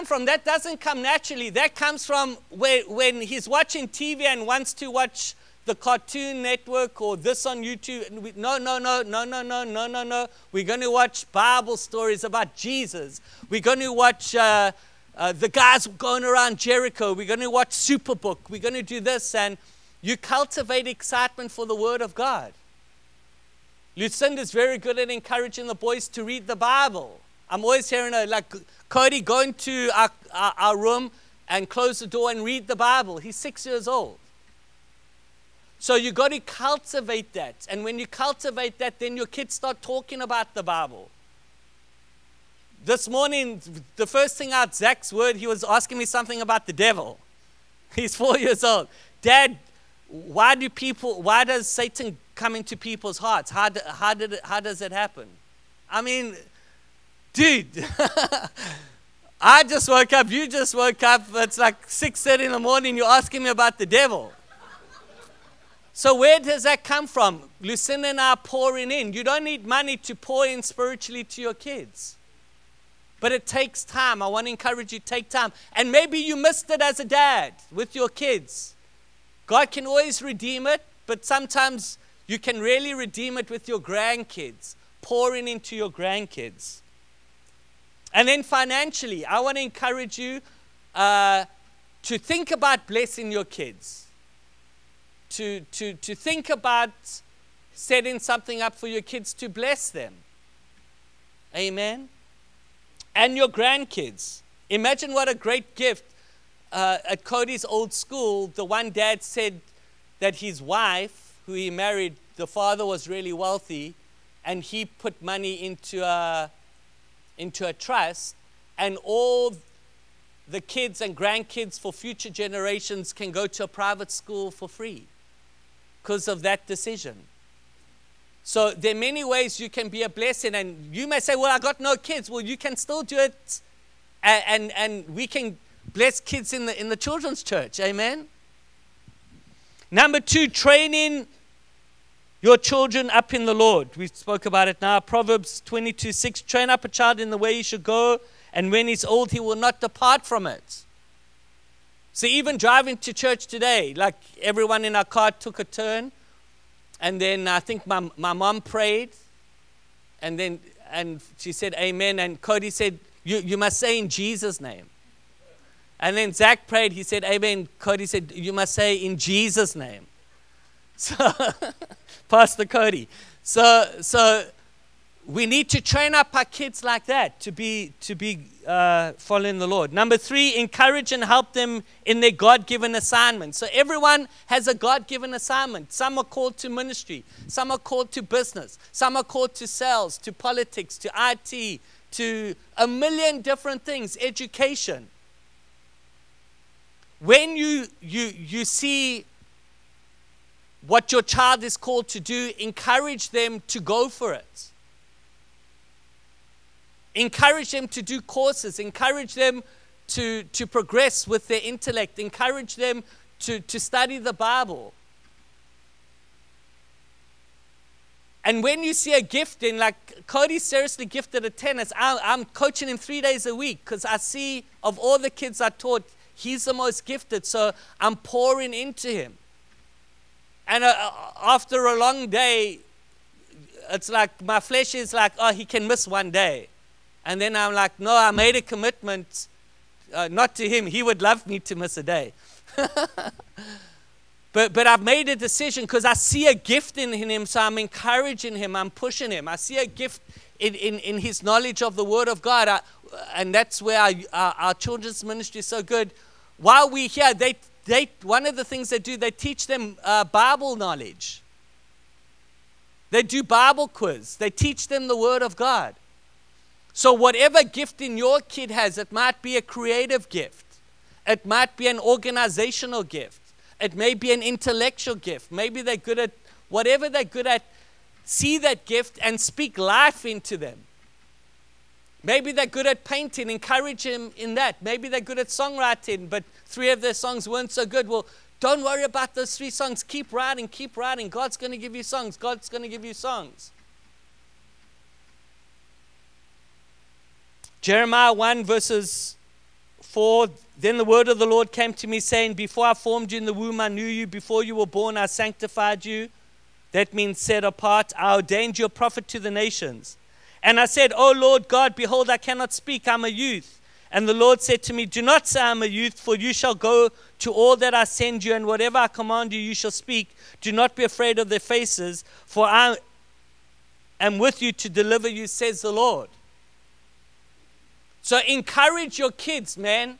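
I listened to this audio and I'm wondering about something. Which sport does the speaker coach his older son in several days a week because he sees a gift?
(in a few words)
Tennis.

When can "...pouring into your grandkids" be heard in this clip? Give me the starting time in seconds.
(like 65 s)
85 s.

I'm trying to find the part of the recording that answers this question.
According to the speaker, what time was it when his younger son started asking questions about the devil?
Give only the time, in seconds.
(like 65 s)
61 s.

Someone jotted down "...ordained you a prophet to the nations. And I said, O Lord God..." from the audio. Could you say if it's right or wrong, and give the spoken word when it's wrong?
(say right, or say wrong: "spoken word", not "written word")
right.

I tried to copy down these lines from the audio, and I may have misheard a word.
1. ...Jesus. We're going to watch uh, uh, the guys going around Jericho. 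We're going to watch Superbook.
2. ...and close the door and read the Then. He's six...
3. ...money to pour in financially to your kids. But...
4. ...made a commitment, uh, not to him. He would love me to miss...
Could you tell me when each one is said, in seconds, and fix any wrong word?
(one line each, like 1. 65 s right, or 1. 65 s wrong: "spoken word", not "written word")
1. 12 s right
2. 31 s wrong: "Bible", not "Then"
3. 69 s wrong: "spiritually", not "financially"
4. 238 s right.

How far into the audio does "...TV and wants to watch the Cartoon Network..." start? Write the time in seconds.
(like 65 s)
3 s.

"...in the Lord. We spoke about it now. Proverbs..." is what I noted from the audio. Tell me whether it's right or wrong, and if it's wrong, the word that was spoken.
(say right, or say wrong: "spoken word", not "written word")
right.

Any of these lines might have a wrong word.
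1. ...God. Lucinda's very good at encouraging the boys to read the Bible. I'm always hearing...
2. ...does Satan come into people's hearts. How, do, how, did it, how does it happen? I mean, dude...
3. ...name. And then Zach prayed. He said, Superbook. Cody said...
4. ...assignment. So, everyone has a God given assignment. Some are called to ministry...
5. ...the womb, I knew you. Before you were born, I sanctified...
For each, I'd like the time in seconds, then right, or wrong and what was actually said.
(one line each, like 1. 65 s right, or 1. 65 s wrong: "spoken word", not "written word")
1. 22 s right
2. 51 s right
3. 164 s wrong: "Amen", not "Superbook"
4. 182 s right
5. 303 s right.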